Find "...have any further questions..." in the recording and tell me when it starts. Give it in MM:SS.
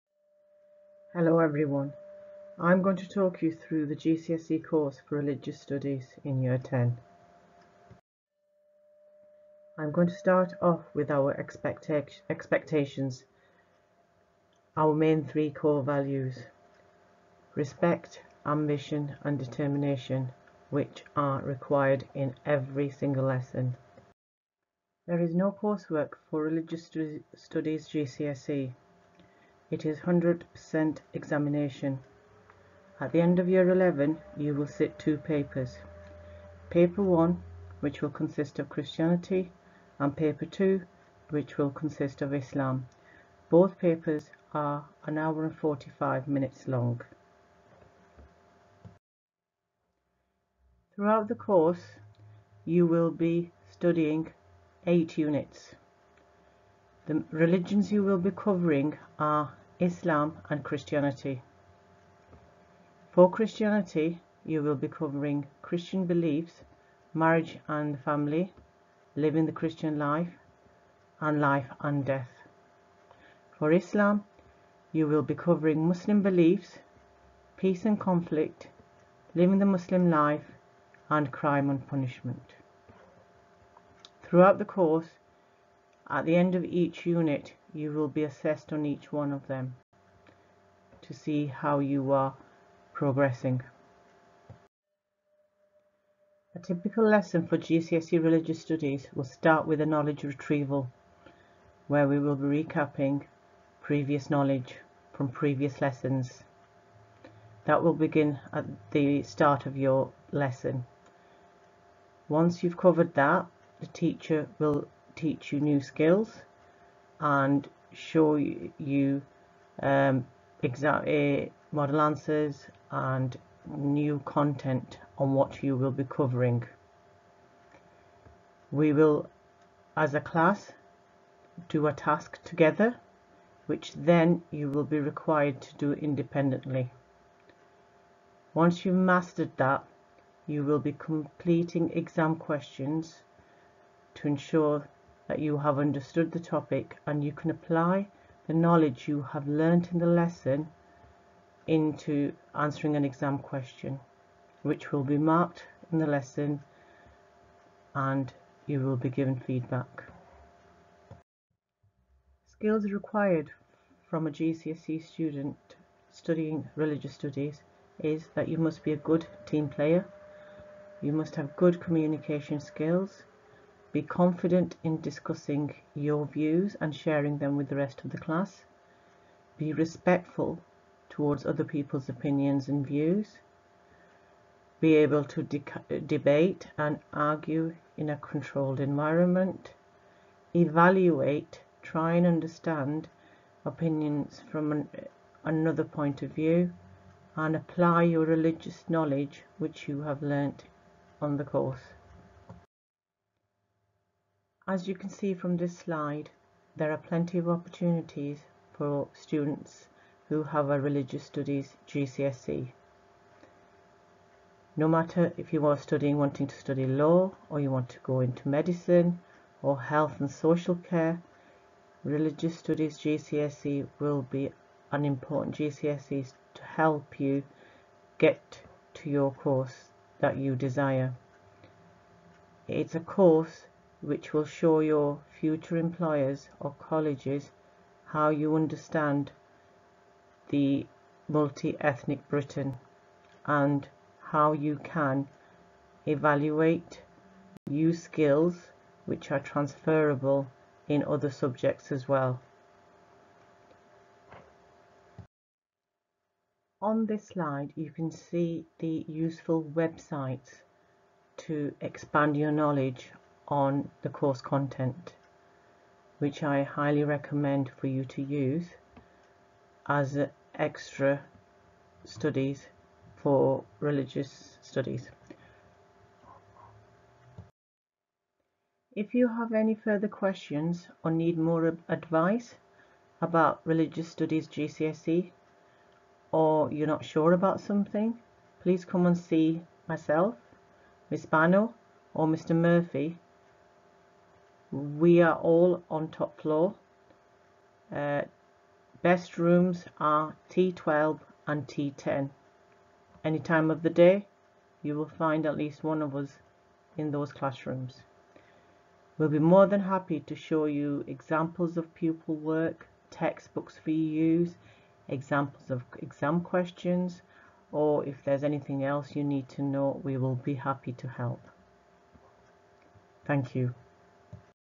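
04:39.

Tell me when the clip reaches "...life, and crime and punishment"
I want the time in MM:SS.
01:20.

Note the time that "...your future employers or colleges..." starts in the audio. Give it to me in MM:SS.
03:54.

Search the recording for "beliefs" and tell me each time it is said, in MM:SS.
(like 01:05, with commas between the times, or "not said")
01:06, 01:16.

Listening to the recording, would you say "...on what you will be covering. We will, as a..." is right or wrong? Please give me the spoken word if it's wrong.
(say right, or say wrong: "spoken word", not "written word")
right.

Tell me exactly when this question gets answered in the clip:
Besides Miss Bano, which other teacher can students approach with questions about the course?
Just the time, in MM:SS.
04:52.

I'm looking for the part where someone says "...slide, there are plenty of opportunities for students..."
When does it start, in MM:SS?
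03:25.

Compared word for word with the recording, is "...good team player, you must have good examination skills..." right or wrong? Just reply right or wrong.
wrong.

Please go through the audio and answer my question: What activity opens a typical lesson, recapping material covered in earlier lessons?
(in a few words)
Knowledge retrieval.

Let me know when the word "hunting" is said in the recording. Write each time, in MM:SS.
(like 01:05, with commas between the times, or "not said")
not said.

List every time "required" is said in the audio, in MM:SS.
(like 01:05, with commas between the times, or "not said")
00:21, 02:14, 02:42.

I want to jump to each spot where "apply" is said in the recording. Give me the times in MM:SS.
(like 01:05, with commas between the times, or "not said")
02:27, 03:17.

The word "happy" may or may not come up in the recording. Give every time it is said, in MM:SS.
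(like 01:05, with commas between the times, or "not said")
05:09, 05:20.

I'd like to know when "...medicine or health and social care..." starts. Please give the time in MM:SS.
03:38.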